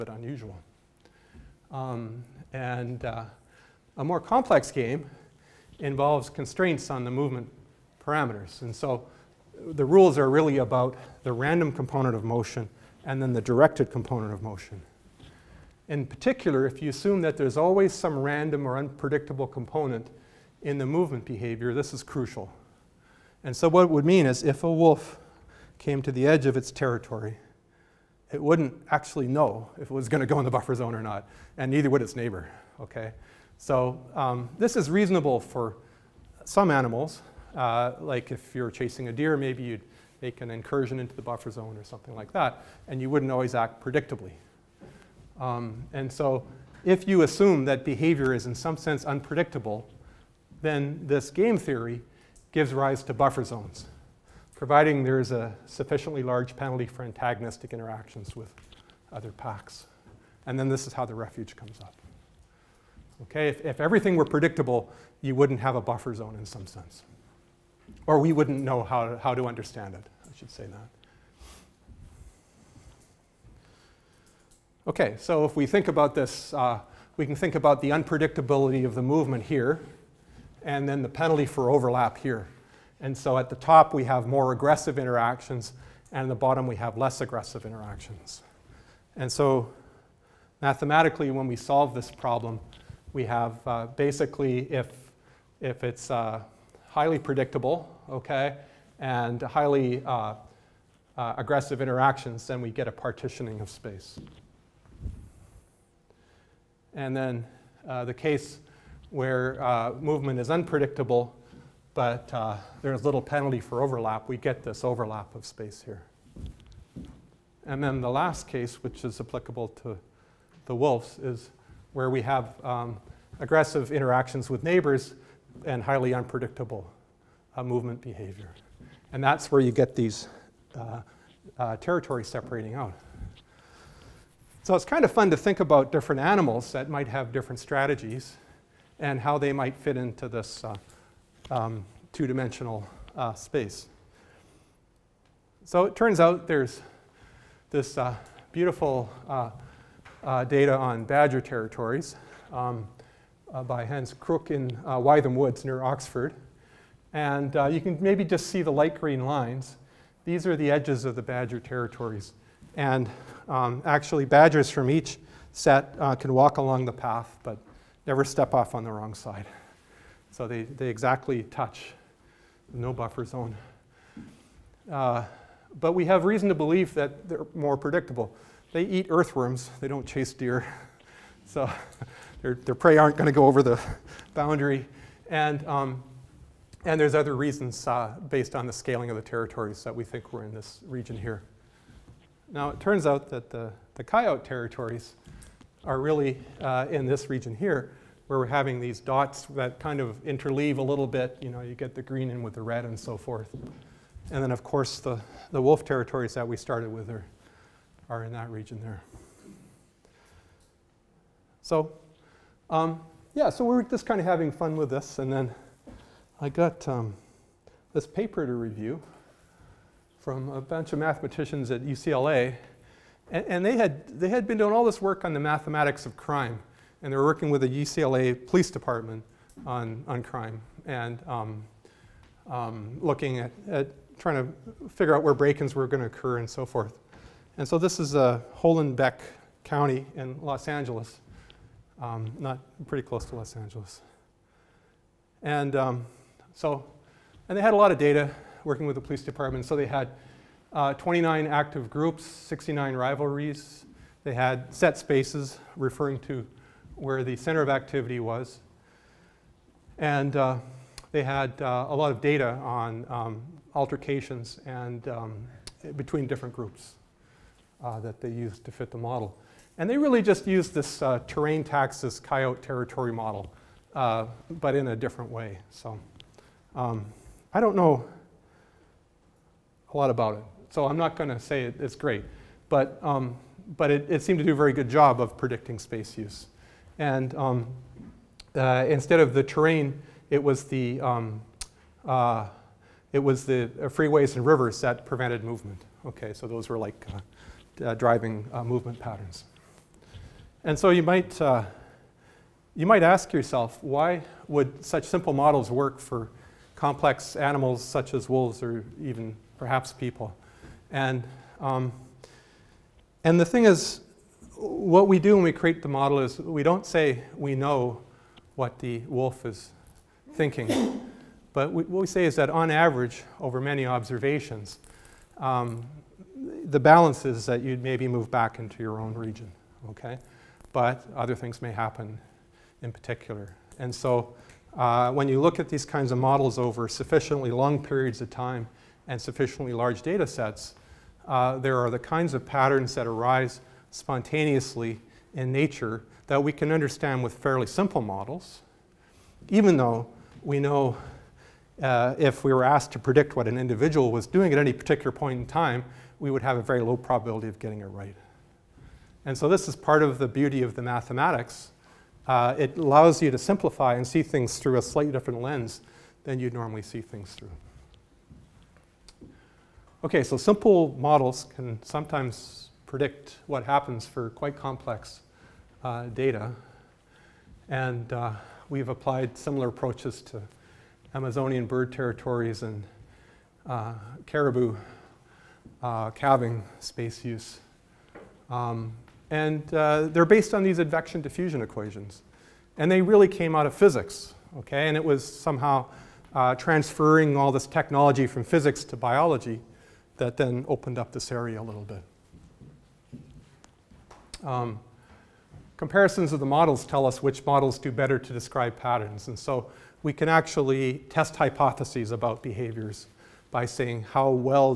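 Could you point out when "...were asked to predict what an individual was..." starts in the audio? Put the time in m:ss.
5:52.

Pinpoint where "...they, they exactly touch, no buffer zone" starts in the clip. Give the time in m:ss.
2:50.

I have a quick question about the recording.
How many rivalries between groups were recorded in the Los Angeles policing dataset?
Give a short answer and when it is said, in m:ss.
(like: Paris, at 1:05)
69, at 4:12.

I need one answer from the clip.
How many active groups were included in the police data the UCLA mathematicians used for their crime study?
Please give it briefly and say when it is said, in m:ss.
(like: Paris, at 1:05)
29, at 4:10.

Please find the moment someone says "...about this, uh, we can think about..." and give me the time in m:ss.
1:15.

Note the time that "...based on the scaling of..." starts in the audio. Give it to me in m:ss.
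3:08.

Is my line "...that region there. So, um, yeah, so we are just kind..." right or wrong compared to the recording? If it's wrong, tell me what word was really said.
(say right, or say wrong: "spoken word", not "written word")
right.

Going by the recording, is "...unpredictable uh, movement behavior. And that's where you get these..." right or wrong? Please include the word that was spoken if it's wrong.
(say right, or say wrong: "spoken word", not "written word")
right.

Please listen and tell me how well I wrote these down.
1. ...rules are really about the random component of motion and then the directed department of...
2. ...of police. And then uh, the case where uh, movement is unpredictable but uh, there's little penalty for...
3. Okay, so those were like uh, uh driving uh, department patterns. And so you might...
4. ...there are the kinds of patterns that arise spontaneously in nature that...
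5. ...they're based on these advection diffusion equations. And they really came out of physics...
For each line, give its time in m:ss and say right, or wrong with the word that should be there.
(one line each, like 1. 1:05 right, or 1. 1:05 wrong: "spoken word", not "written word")
1. 0:09 wrong: "component", not "department"
2. 1:43 wrong: "space", not "police"
3. 4:56 wrong: "movement", not "department"
4. 5:41 right
5. 6:30 right.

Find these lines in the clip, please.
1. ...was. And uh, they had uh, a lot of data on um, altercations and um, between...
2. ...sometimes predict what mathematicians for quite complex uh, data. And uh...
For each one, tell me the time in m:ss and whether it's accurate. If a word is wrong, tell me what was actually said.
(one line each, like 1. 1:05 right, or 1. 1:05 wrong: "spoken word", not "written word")
1. 4:18 right
2. 6:11 wrong: "happens", not "mathematicians".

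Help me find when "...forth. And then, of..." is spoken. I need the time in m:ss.
3:23.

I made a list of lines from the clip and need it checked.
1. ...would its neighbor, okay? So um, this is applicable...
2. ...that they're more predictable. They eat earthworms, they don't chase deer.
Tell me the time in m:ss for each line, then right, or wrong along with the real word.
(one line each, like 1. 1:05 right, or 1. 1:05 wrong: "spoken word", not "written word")
1. 0:31 wrong: "reasonable", not "applicable"
2. 2:56 right.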